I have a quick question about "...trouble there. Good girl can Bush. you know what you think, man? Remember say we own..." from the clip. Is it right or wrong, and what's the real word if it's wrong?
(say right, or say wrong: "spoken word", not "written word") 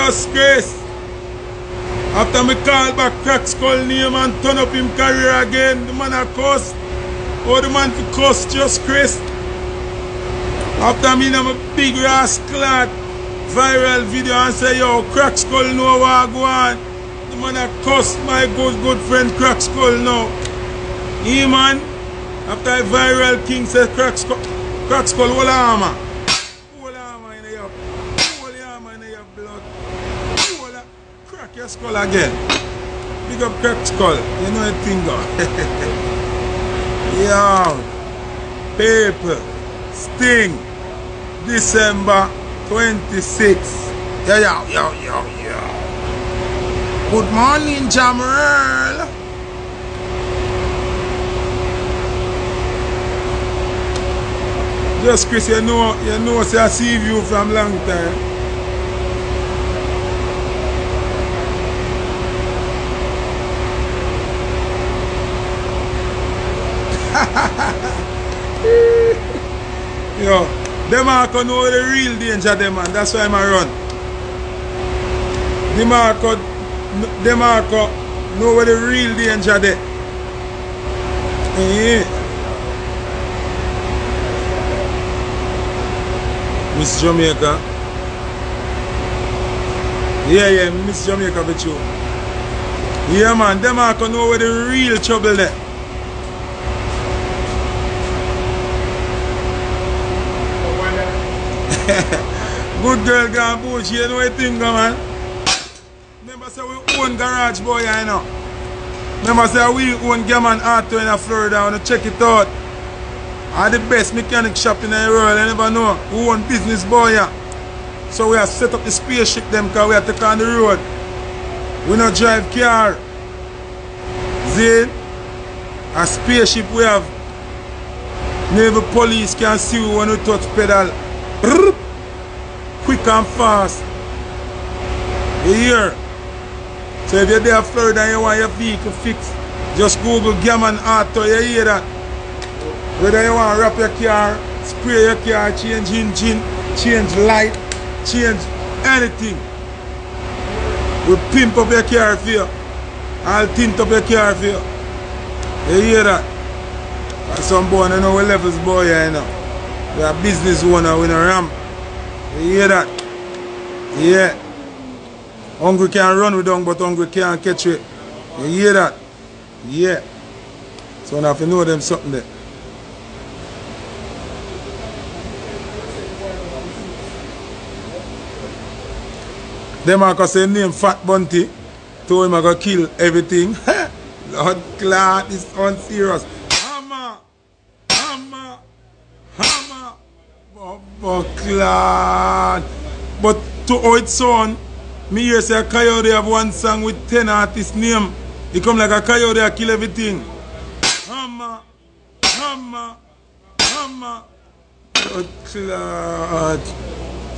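right.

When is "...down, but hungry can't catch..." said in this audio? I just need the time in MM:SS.
02:46.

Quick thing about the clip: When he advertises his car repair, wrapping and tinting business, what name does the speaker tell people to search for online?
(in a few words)
Gammon Auto.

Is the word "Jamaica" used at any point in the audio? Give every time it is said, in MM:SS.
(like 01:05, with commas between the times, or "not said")
01:27, 01:31.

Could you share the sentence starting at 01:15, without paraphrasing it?
The Marco, the Marco know where the real danger there.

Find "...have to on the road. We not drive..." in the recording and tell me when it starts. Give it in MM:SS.
01:59.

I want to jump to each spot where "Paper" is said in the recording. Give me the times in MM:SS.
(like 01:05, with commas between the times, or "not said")
00:38.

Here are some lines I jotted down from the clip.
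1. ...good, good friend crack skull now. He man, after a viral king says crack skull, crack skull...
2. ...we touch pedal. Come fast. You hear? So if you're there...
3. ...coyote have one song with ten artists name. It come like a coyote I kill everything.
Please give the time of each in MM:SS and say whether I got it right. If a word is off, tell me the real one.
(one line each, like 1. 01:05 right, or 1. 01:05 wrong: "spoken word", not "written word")
1. 00:18 right
2. 02:10 right
3. 03:15 right.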